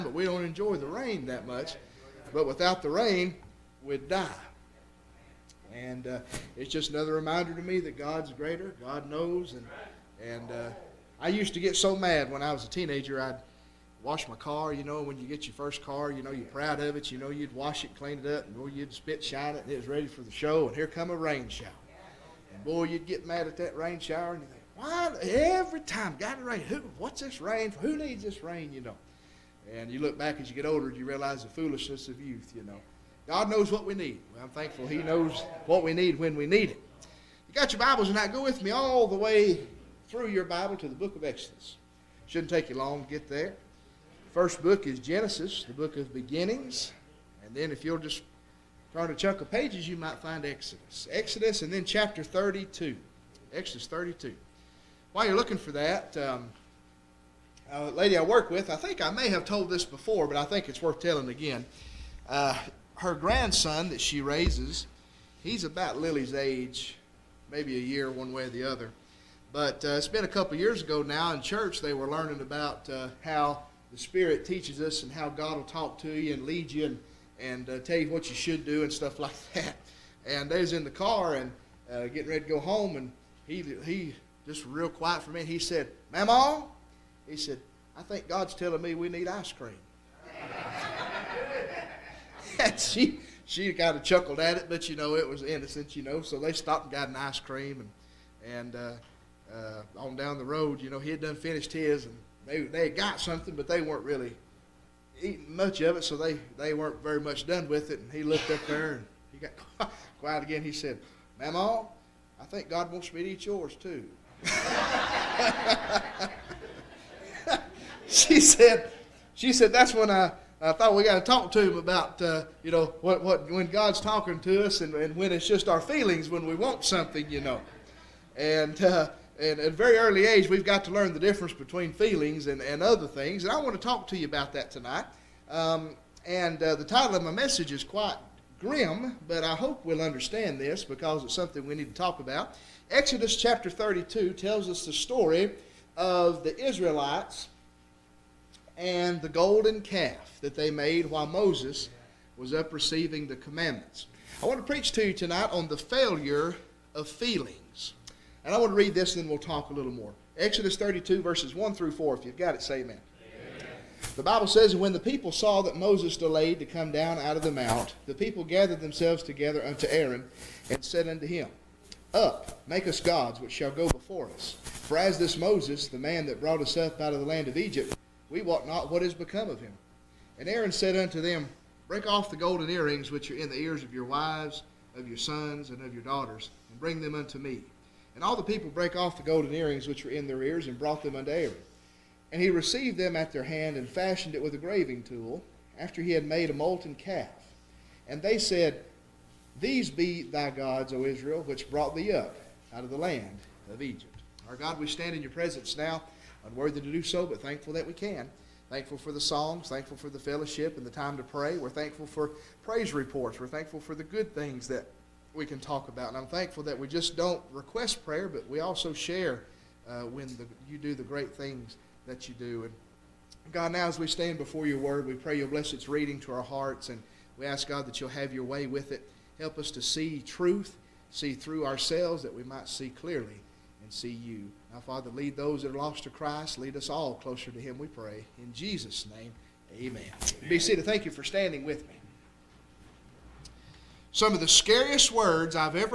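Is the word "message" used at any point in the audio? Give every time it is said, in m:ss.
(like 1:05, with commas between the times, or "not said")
2:17.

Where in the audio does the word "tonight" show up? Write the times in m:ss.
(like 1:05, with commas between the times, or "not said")
0:38, 2:14, 2:35.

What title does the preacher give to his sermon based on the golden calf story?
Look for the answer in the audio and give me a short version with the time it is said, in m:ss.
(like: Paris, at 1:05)
The failure of feeling, at 2:35.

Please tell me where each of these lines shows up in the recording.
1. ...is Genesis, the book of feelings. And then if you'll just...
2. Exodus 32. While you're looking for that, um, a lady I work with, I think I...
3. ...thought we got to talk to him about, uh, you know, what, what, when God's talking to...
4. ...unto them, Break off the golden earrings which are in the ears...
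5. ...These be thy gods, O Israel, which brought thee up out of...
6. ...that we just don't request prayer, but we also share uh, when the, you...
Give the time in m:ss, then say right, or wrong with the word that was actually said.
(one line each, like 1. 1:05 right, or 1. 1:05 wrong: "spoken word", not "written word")
1. 0:44 wrong: "beginnings", not "feelings"
2. 0:53 right
3. 2:00 right
4. 3:00 right
5. 3:19 right
6. 3:36 right.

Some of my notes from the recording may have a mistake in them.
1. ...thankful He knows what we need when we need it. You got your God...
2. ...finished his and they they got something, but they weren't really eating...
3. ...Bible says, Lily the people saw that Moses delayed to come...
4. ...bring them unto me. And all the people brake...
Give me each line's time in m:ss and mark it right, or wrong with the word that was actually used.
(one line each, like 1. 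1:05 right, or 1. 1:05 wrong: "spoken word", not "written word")
1. 0:34 wrong: "Bibles", not "God"
2. 1:41 right
3. 2:44 wrong: "When", not "Lily"
4. 3:06 right.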